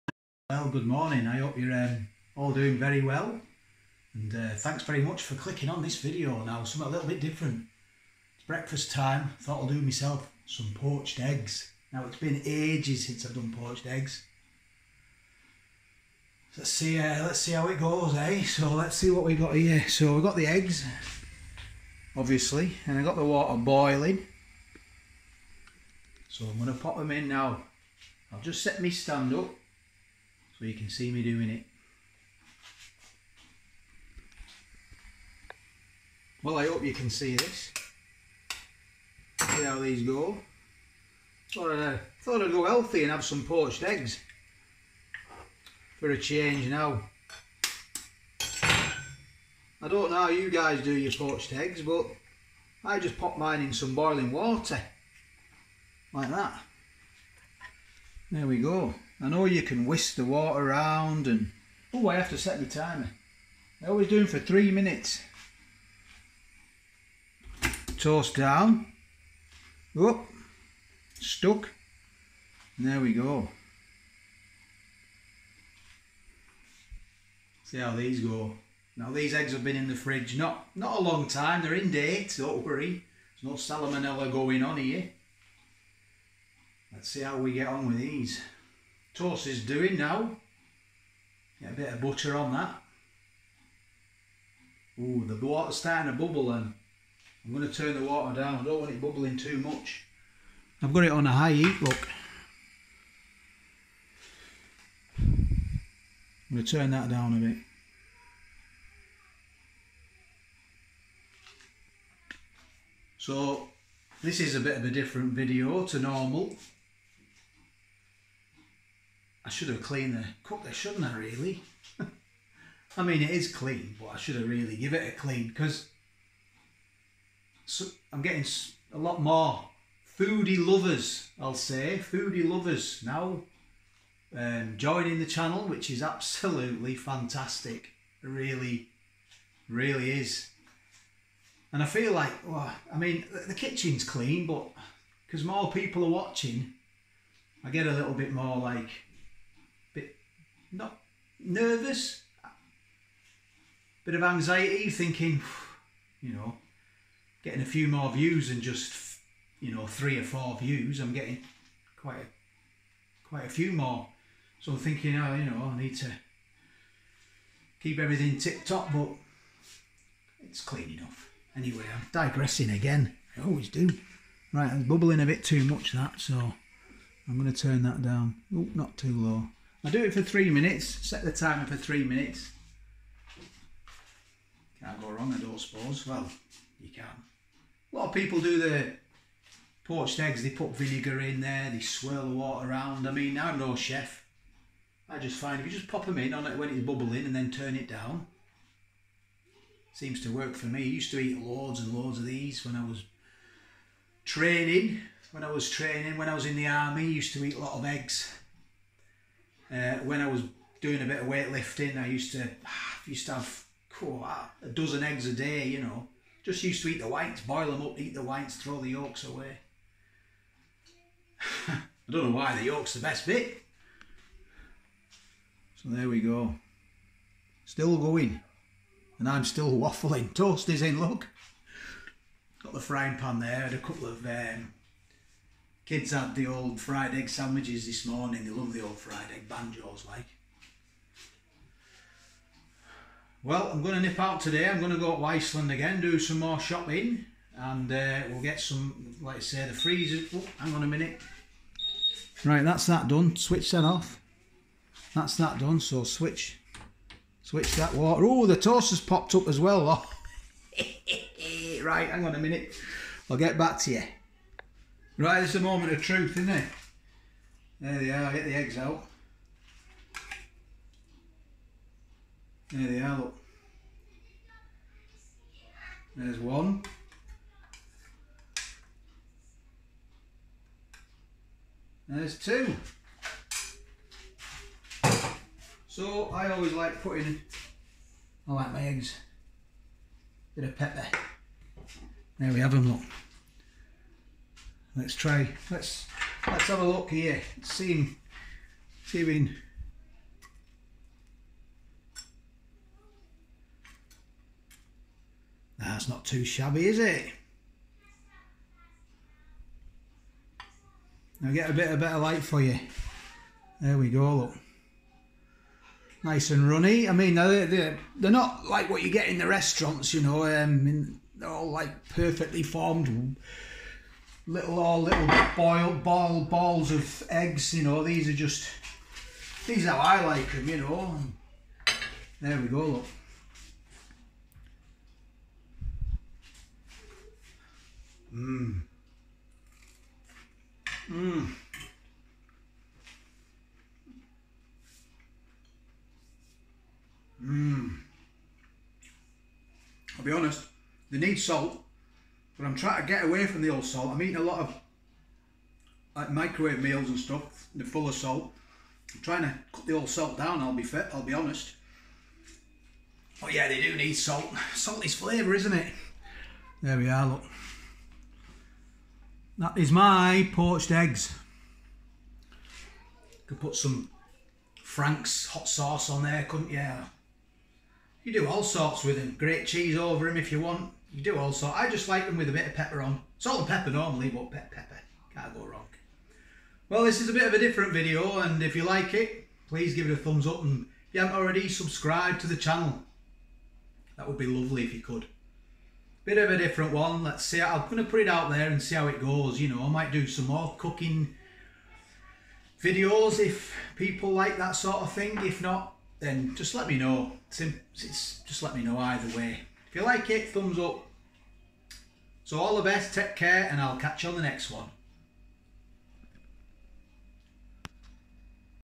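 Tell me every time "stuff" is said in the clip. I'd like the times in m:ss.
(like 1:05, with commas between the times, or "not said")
5:57.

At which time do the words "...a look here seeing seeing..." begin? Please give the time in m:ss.
4:56.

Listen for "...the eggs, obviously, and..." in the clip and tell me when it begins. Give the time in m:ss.
0:20.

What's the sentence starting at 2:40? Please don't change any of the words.
I'm getting quite a, quite a few more.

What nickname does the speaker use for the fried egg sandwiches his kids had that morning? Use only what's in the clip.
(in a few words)
banjos.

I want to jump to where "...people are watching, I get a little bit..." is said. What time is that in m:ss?
2:25.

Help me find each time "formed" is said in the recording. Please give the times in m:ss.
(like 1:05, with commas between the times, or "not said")
5:22.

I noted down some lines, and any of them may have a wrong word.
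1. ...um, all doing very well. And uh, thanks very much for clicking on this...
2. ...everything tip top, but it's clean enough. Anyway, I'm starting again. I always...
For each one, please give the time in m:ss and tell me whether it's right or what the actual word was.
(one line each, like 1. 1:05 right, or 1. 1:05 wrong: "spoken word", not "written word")
1. 0:01 right
2. 2:47 wrong: "digressing", not "starting".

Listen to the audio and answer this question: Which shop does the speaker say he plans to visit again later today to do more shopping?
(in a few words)
Iceland.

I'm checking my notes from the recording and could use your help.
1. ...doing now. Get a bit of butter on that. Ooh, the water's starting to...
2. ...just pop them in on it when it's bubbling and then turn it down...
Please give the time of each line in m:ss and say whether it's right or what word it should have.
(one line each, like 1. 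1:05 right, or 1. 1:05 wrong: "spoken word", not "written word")
1. 1:29 right
2. 3:15 right.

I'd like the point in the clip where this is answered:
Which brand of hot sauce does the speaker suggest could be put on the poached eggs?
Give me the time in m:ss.
6:14.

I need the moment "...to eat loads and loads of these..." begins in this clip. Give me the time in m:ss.
3:21.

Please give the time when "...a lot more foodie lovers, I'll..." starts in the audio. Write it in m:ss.
2:08.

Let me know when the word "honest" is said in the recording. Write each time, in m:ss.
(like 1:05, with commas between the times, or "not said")
5:50, 6:01.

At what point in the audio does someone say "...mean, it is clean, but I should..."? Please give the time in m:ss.
2:03.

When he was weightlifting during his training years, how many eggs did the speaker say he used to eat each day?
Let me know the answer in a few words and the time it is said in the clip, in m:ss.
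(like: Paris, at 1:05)
a dozen, at 3:34.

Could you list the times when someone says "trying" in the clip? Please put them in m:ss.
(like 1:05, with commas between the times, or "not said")
5:52, 5:59.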